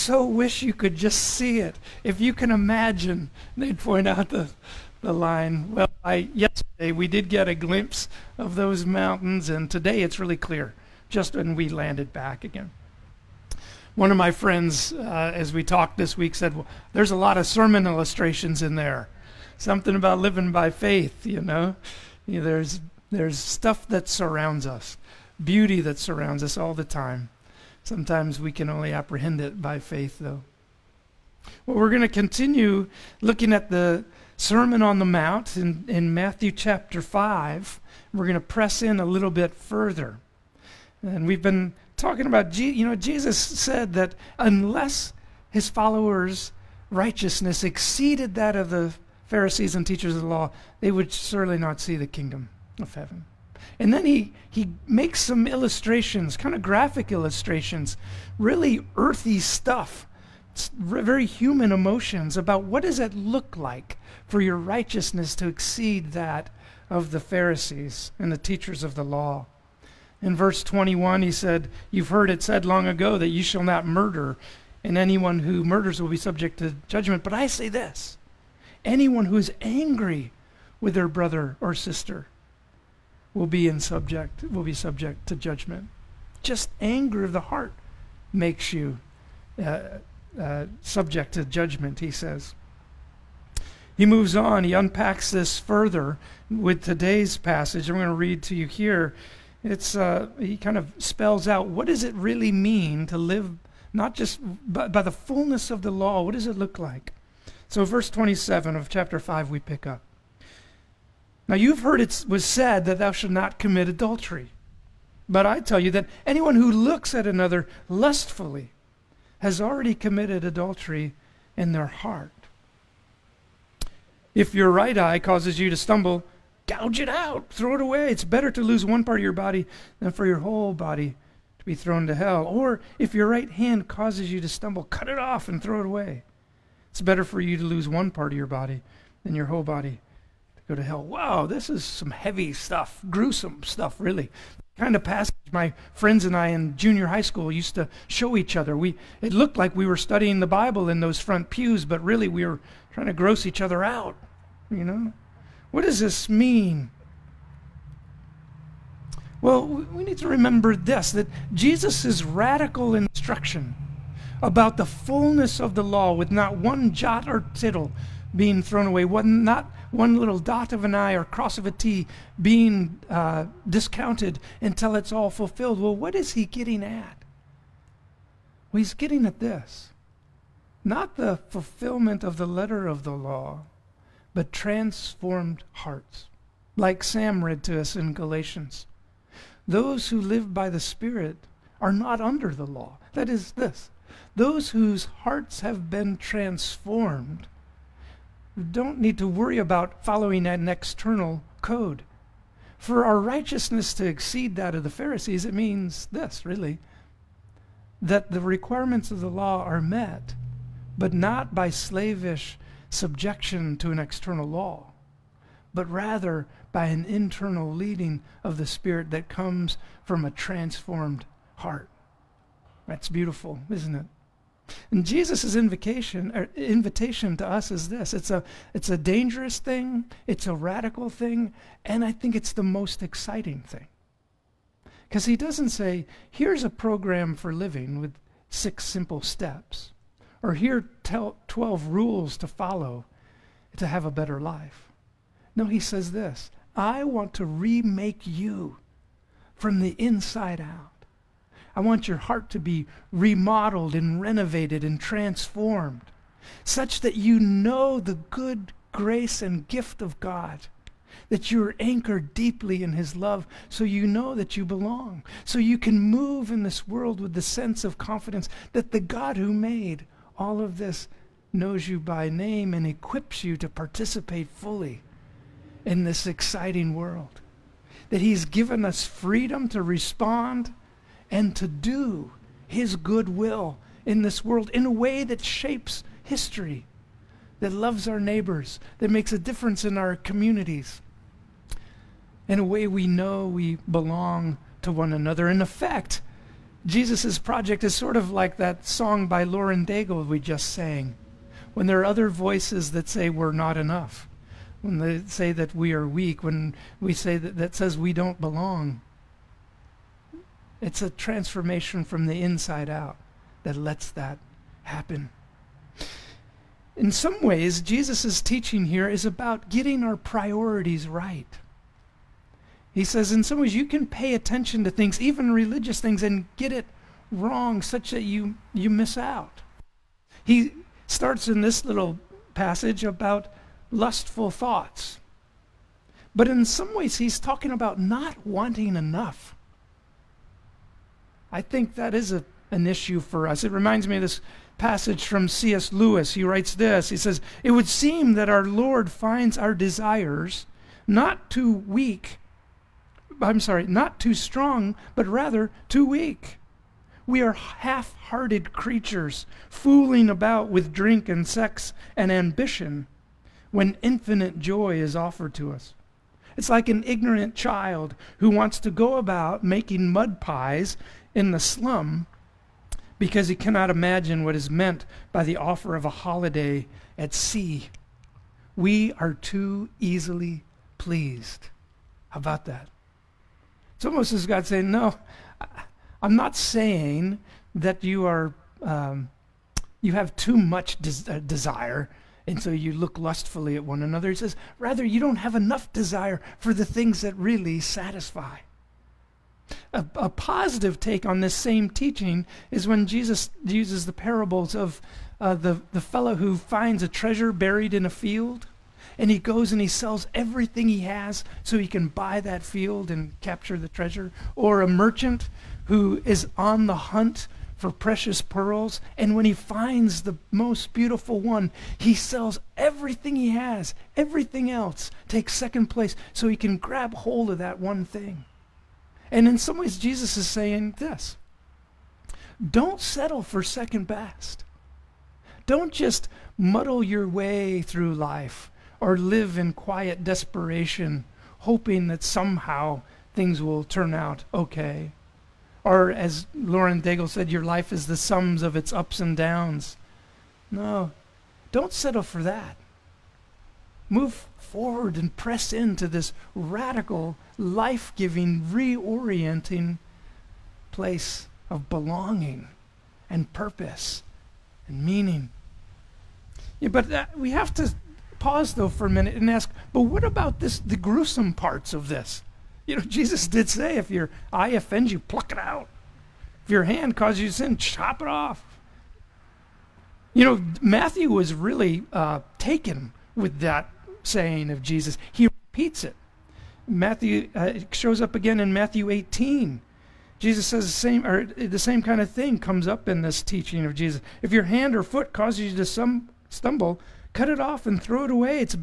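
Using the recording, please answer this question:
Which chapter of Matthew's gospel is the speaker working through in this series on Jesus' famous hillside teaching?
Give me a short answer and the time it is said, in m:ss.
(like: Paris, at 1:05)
Chapter 5, at 0:36.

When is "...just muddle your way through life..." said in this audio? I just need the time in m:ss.
7:15.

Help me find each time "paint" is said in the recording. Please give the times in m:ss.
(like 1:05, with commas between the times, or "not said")
not said.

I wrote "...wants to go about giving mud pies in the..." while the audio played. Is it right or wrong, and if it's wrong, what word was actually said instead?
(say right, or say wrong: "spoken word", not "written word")
wrong: "making", not "giving".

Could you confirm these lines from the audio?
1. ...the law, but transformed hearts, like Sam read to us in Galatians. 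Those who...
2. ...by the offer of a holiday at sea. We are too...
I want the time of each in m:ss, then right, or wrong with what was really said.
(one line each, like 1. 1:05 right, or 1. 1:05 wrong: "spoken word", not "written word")
1. 3:03 right
2. 6:15 right.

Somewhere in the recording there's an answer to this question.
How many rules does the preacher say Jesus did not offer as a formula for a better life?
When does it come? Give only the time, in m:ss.
4:01.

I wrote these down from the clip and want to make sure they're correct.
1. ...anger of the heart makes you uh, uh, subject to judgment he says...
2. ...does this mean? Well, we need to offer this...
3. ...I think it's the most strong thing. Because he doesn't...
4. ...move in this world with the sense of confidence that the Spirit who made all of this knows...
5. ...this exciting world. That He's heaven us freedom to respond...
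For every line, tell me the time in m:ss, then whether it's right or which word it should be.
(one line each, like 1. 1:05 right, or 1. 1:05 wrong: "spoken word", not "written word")
1. 1:26 right
2. 2:35 wrong: "remember", not "offer"
3. 3:52 wrong: "exciting", not "strong"
4. 4:25 wrong: "God", not "Spirit"
5. 4:36 wrong: "given", not "heaven".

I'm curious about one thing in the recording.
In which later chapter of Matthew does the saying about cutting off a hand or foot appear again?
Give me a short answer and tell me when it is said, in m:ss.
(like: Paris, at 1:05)
Chapter 18, at 8:08.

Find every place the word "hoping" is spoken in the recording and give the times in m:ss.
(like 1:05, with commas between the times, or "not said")
7:21.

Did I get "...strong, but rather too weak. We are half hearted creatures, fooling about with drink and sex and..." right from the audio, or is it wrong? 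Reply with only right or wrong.
right.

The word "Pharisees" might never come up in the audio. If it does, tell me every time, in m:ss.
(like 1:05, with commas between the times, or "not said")
0:49, 1:07, 3:24.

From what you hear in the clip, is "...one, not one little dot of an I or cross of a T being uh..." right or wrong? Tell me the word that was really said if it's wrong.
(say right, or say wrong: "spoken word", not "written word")
right.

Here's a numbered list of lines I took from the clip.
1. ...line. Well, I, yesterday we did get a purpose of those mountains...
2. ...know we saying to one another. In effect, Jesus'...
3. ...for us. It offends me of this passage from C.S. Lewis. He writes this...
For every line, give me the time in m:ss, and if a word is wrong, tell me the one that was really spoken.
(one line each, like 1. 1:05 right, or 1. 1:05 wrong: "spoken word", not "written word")
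1. 0:05 wrong: "glimpse", not "purpose"
2. 4:53 wrong: "belong", not "saying"
3. 5:43 wrong: "reminds", not "offends".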